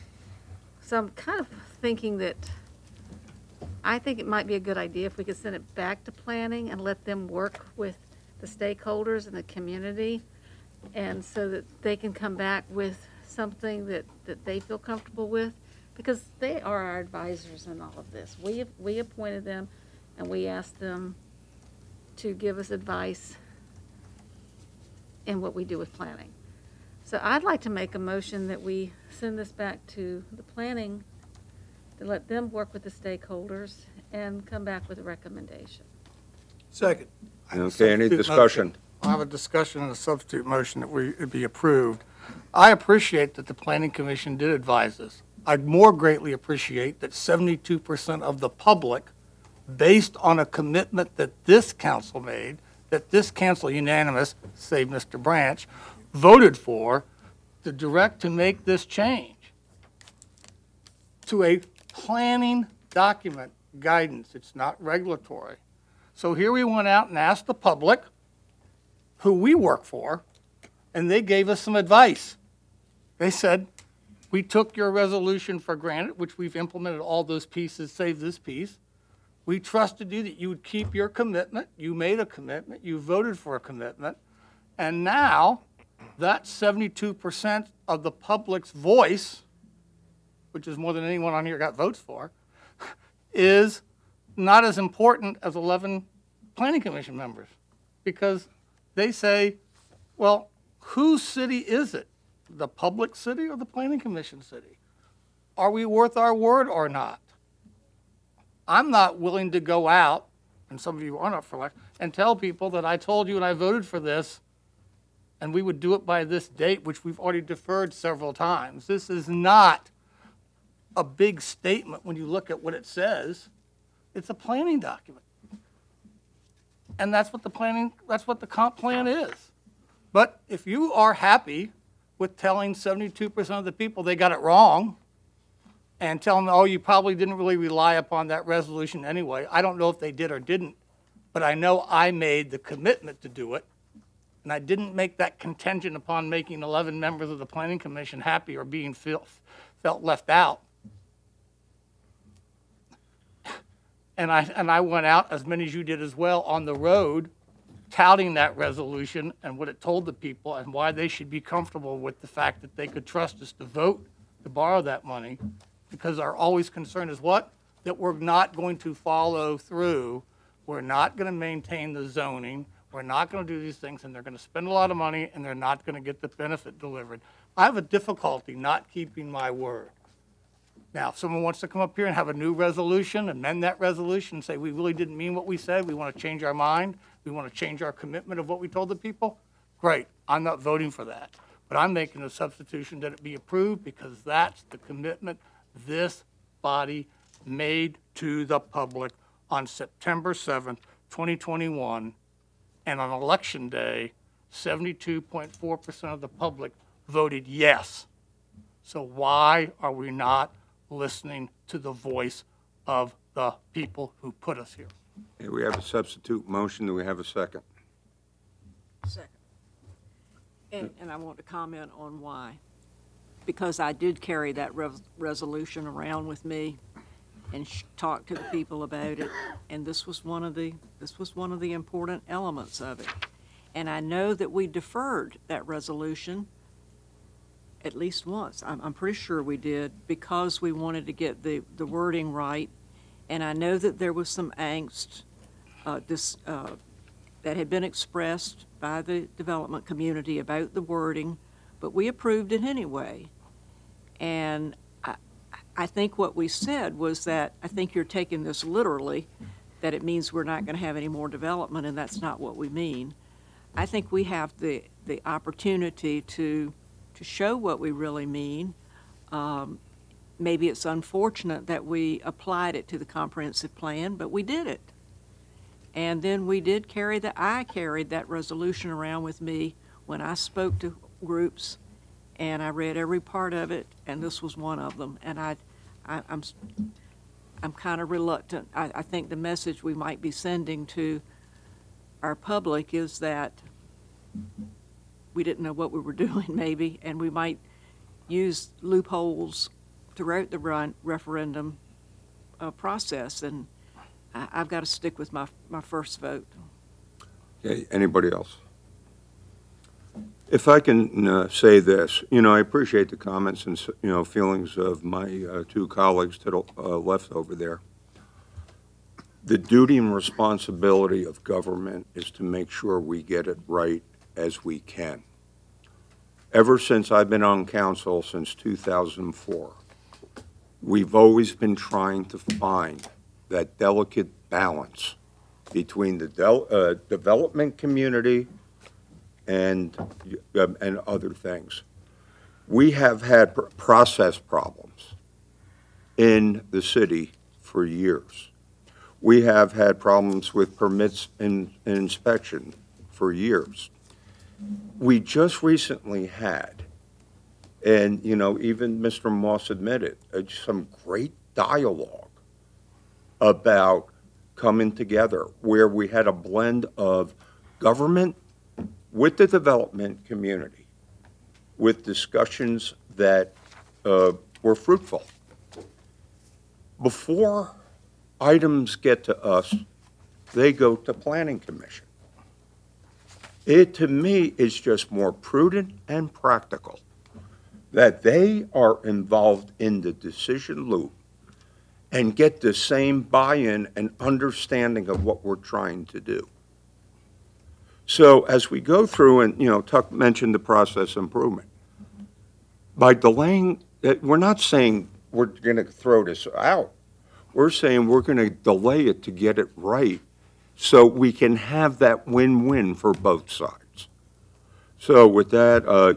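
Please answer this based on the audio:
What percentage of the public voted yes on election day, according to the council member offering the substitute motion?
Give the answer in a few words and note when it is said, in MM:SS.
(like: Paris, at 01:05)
72.4%, at 03:24.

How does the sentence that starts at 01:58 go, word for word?
This is not a big statement when you look at what it says.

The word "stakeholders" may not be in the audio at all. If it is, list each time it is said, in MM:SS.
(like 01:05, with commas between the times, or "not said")
00:08, 00:32.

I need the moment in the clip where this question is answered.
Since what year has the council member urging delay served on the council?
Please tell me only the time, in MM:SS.
05:28.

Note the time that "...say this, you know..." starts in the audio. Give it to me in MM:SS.
05:11.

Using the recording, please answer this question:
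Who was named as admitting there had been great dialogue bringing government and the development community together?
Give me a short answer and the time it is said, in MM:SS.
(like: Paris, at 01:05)
Mr. Moss, at 05:58.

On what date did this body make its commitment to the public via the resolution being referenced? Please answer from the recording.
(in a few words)
September 7th, 2021.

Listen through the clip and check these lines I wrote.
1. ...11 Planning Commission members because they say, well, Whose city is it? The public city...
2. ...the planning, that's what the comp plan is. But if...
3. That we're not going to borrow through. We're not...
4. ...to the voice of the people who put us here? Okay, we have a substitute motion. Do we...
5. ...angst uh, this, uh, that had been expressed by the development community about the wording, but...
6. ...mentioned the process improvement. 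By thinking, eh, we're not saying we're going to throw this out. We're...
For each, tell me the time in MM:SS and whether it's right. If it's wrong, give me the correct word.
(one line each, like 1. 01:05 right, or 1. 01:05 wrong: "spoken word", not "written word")
1. 01:35 right
2. 02:07 right
3. 02:47 wrong: "follow", not "borrow"
4. 03:31 right
5. 04:04 right
6. 06:40 wrong: "delaying", not "thinking".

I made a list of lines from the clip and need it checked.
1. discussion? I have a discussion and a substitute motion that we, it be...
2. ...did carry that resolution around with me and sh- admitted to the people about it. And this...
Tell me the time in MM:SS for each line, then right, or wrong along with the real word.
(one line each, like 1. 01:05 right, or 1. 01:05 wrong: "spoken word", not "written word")
1. 00:38 right
2. 03:43 wrong: "talked", not "admitted".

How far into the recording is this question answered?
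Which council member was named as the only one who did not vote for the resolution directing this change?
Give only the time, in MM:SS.
00:54.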